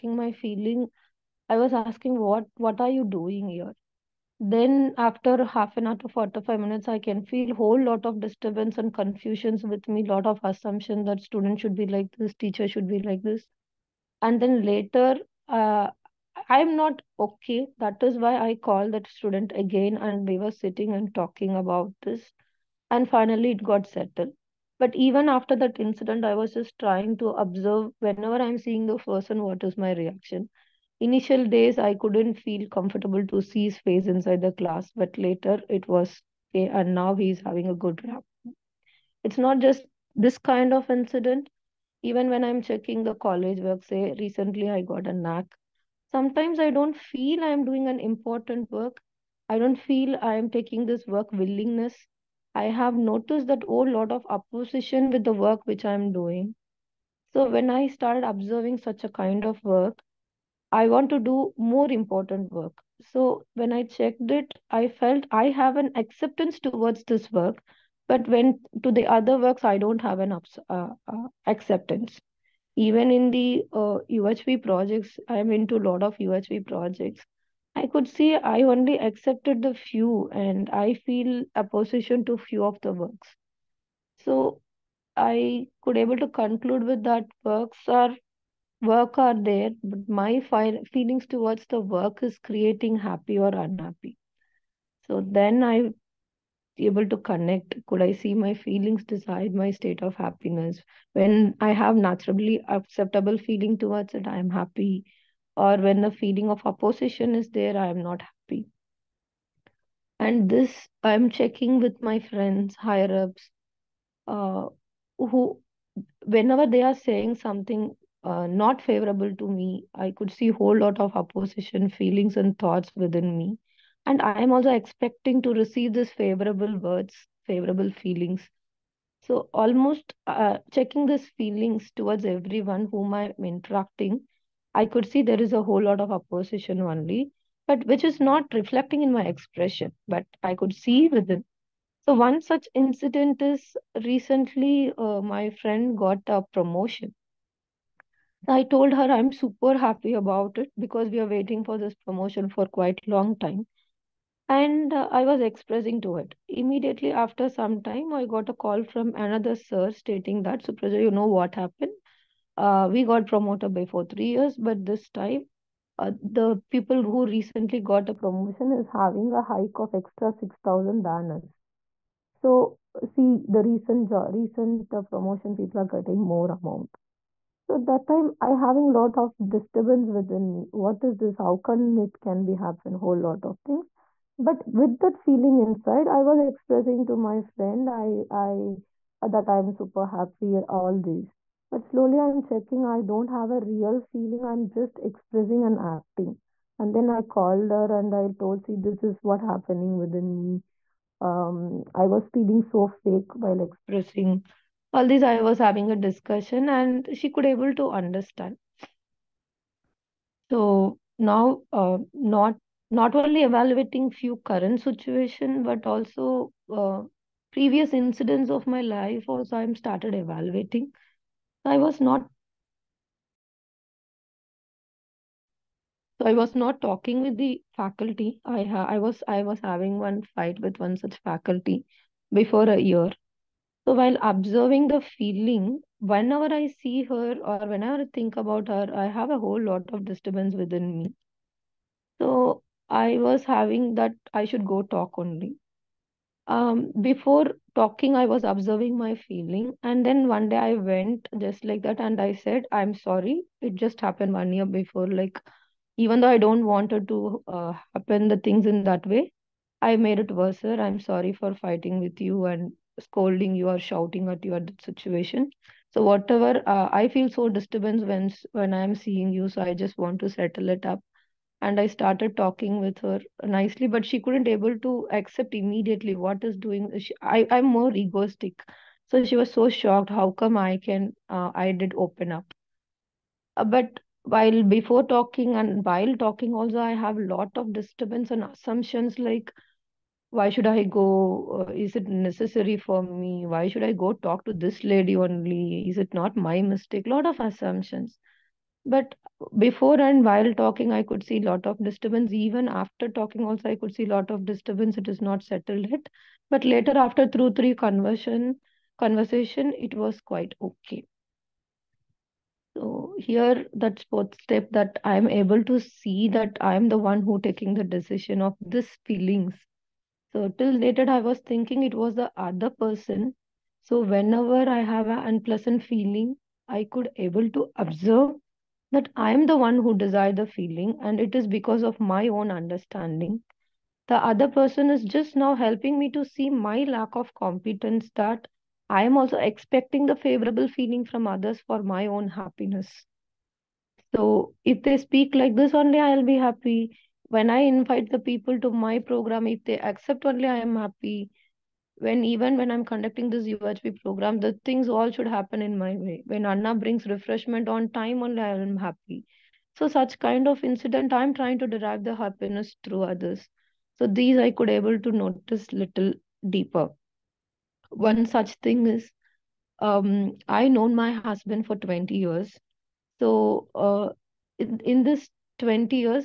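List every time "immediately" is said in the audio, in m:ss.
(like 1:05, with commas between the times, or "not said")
2:36, 4:35.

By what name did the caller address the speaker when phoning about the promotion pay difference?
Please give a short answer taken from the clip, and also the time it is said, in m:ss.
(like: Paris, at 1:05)
Supraja, at 2:40.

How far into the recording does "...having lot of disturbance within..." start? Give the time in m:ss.
2:58.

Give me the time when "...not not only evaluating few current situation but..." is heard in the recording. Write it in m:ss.
3:32.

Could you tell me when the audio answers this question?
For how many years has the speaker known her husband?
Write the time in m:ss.
6:11.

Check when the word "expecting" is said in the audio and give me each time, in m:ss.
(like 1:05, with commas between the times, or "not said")
2:04, 5:39.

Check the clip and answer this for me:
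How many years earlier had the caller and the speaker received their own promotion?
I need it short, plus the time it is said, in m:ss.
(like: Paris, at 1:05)
3 years, at 2:44.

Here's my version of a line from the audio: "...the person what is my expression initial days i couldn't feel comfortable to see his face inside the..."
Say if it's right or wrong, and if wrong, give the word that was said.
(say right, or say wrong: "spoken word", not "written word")
wrong: "reaction", not "expression".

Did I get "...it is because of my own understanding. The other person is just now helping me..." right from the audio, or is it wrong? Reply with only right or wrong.
right.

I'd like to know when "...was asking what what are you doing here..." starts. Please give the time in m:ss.
0:01.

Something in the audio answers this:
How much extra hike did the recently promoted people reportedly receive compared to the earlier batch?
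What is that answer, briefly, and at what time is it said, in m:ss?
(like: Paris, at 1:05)
6,000, at 2:50.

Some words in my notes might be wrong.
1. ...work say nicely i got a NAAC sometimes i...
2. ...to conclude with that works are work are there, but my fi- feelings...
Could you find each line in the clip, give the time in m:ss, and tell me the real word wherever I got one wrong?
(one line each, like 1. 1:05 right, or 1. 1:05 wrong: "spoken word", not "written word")
1. 0:43 wrong: "recently", not "nicely"
2. 1:26 right.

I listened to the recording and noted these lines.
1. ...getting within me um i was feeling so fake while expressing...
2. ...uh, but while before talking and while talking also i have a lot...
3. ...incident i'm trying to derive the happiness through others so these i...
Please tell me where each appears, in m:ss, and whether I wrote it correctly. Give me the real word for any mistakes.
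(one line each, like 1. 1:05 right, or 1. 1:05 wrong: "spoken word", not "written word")
1. 3:19 wrong: "happening", not "getting"
2. 4:43 right
3. 6:00 right.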